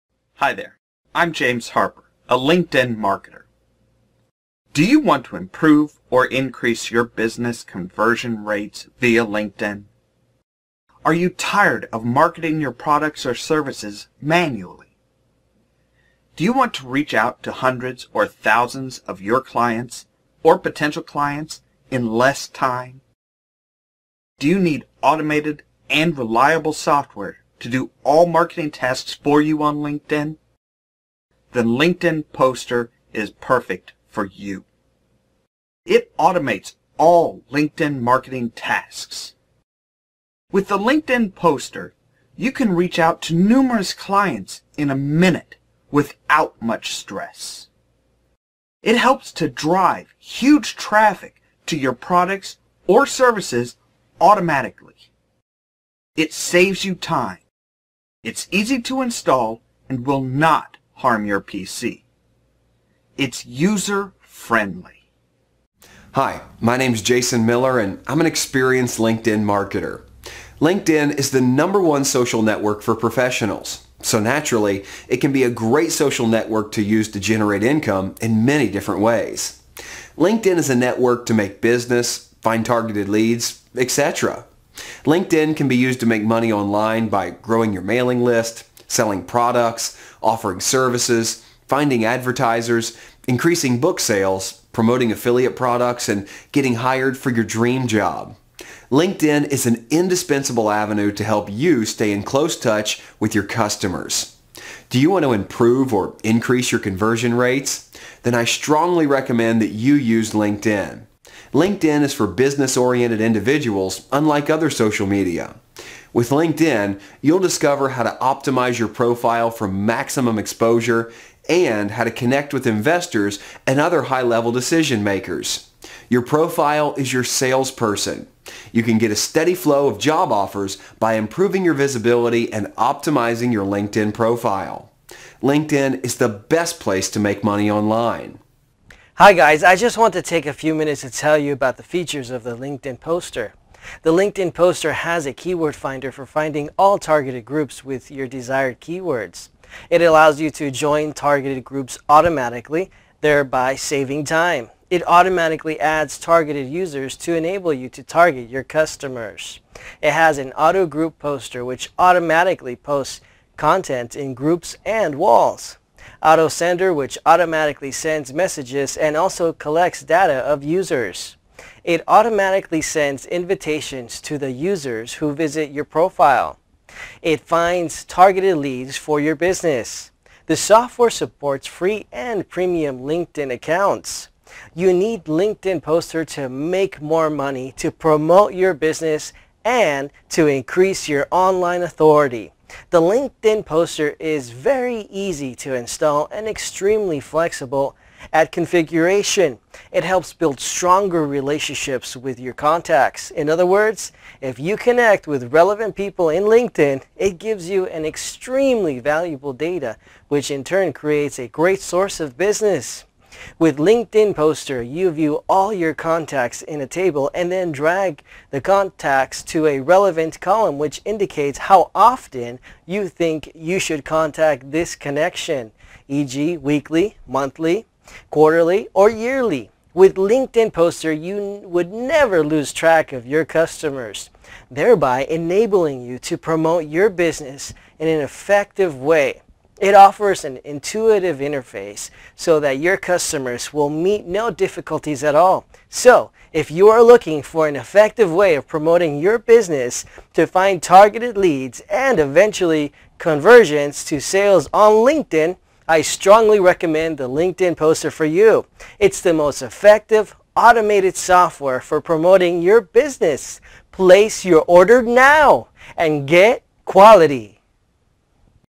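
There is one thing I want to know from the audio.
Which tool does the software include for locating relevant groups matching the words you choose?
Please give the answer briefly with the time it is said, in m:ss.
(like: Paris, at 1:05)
keyword finder, at 2:25.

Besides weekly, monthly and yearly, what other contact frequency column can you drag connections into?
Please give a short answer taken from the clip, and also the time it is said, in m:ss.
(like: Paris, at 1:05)
quarterly, at 3:48.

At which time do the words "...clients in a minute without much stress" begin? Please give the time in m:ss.
0:43.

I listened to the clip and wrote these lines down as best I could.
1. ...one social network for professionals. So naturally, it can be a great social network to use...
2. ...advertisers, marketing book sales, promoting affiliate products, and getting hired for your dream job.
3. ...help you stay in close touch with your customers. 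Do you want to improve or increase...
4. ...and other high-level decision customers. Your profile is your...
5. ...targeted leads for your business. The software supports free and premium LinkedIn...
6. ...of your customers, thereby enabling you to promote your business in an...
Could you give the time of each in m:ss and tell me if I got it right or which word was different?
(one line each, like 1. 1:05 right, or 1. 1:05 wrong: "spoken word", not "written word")
1. 1:11 right
2. 1:32 wrong: "increasing", not "marketing"
3. 1:41 right
4. 2:03 wrong: "makers", not "customers"
5. 2:58 right
6. 3:53 right.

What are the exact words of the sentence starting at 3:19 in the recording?
It helps build stronger relationships with your contacts.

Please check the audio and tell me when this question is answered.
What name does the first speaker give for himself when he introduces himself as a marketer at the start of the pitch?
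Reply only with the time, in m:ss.
0:01.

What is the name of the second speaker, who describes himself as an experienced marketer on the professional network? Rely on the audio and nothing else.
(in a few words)
Jason Miller.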